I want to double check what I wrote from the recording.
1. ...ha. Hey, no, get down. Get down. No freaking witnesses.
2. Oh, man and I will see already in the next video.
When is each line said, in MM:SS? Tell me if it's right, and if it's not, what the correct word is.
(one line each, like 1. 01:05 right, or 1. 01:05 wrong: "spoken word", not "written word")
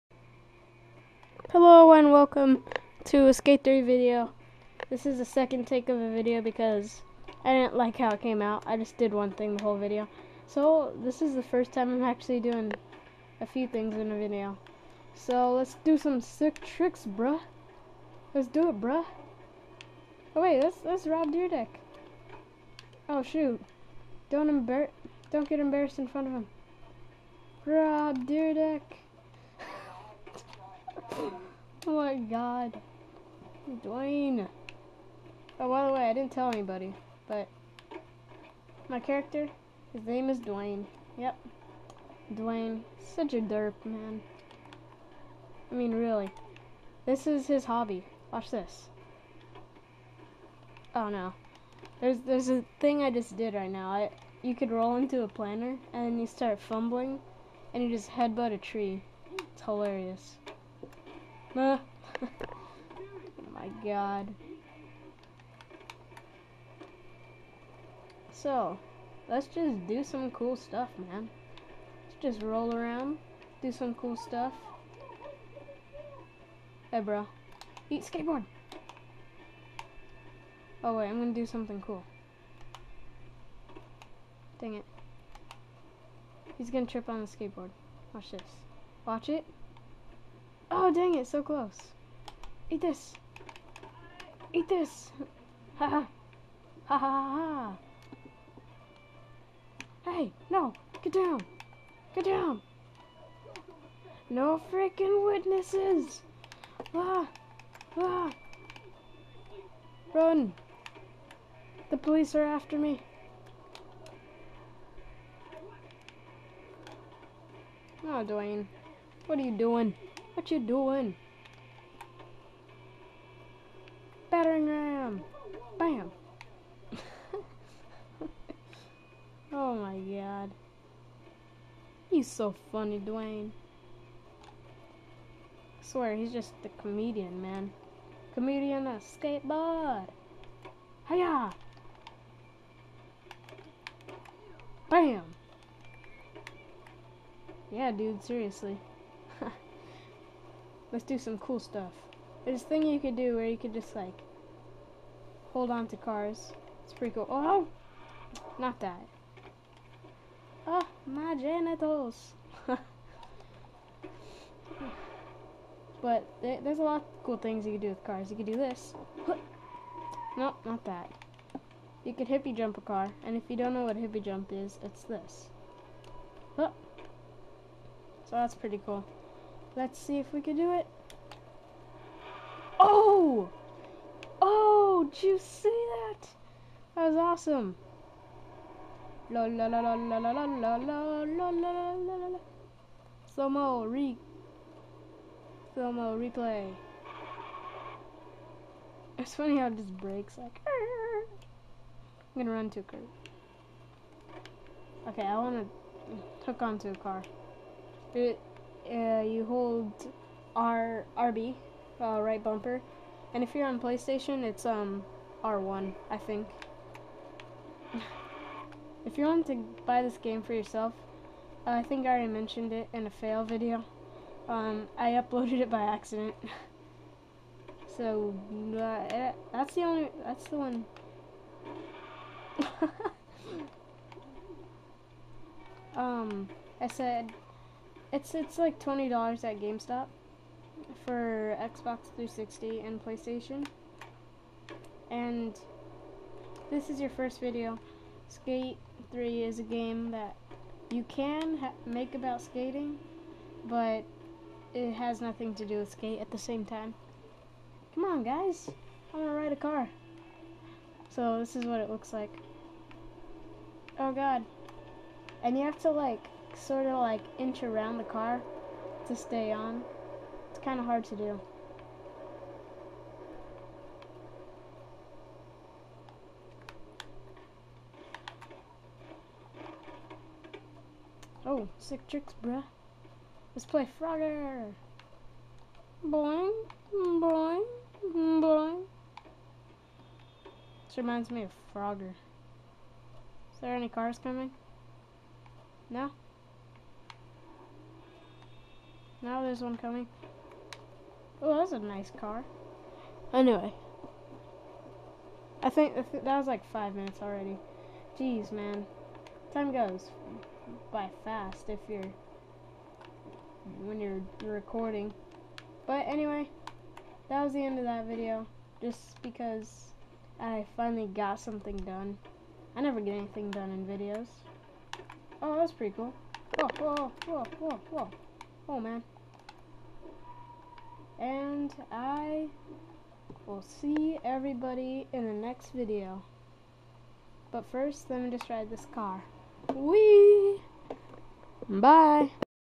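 1. 01:37 right
2. 05:28 wrong: "everybody", not "already".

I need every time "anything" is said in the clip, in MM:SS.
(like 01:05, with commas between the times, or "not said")
05:23.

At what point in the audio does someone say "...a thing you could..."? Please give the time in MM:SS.
02:32.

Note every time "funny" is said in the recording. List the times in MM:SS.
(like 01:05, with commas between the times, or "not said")
02:12, 03:19.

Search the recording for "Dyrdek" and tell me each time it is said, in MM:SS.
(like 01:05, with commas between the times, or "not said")
00:21, 00:28.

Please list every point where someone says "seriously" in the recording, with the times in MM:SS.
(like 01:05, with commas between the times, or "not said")
02:28.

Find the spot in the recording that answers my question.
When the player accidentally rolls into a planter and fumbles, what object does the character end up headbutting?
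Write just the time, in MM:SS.
00:58.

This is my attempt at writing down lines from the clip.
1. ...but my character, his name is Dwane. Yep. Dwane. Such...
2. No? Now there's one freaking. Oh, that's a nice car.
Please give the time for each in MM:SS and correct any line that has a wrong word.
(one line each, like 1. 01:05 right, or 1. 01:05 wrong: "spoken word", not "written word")
1. 00:37 right
2. 04:55 wrong: "coming", not "freaking".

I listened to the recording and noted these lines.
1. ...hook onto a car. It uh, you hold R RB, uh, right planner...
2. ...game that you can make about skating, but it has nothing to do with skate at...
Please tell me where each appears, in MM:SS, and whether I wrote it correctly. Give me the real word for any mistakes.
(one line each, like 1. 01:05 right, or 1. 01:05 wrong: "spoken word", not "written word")
1. 03:26 wrong: "bumper", not "planner"
2. 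04:09 right.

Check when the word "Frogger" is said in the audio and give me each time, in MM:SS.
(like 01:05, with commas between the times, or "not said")
04:43, 04:51.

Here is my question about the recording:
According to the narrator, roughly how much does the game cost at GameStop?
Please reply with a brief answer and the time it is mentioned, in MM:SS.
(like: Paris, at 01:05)
$20, at 03:58.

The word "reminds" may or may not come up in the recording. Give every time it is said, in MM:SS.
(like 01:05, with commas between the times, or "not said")
04:50.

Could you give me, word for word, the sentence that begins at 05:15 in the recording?
But anyway, that was the end of that video.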